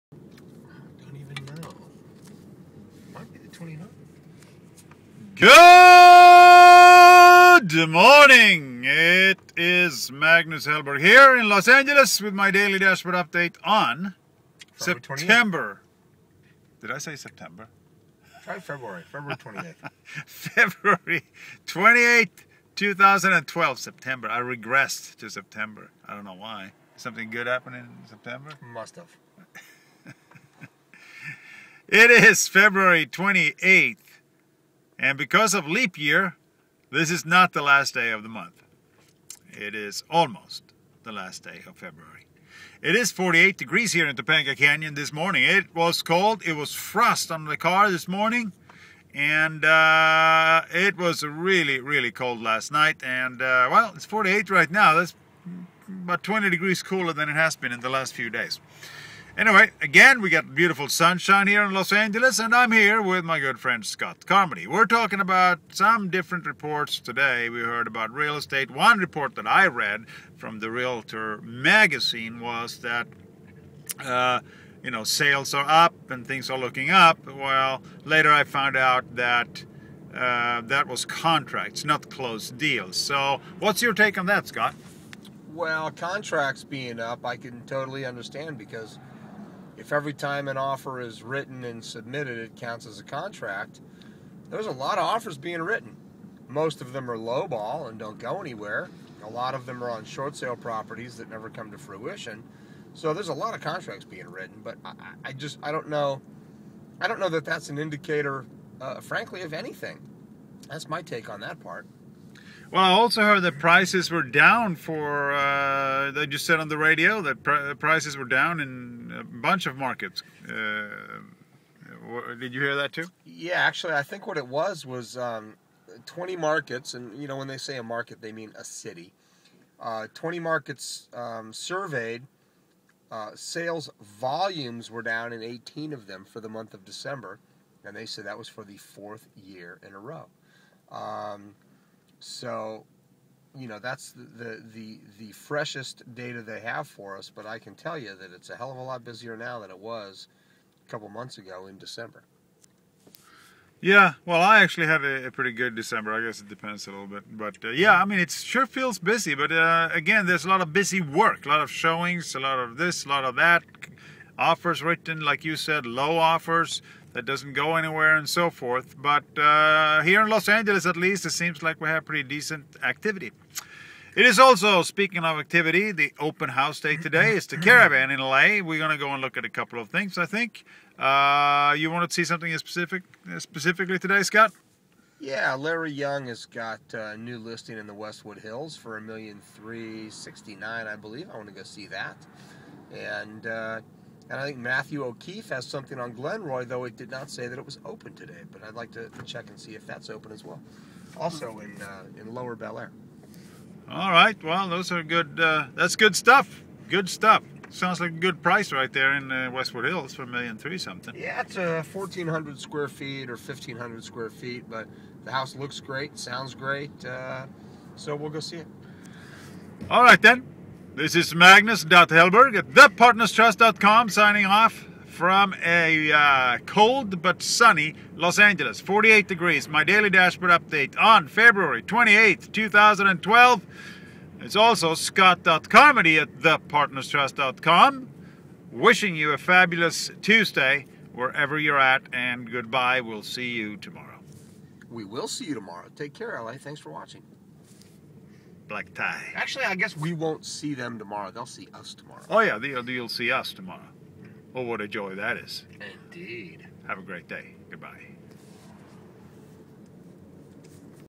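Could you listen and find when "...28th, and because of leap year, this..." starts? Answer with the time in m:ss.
0:33.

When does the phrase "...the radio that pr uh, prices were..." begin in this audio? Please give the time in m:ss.
1:56.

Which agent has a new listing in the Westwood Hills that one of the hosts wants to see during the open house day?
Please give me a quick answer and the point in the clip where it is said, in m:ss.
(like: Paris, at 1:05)
Larry Young, at 3:05.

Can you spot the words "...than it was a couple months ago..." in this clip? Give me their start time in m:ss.
2:29.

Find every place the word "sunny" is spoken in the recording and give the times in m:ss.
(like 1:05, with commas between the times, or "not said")
3:47.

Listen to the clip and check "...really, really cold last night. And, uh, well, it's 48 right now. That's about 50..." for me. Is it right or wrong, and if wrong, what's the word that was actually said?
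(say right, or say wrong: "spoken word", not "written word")
wrong: "20", not "50".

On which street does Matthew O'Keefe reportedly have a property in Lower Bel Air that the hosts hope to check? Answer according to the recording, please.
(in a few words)
Glenroy.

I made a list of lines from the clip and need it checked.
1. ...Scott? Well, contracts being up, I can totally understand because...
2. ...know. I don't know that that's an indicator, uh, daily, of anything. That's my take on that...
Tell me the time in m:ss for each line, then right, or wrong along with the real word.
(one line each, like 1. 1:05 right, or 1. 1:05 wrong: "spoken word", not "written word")
1. 1:24 right
2. 1:45 wrong: "frankly", not "daily".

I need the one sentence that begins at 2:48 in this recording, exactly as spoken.
But uh, here in Los Angeles, at least, it seems like we have pretty decent activity.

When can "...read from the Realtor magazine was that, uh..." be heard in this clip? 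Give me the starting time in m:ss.
1:09.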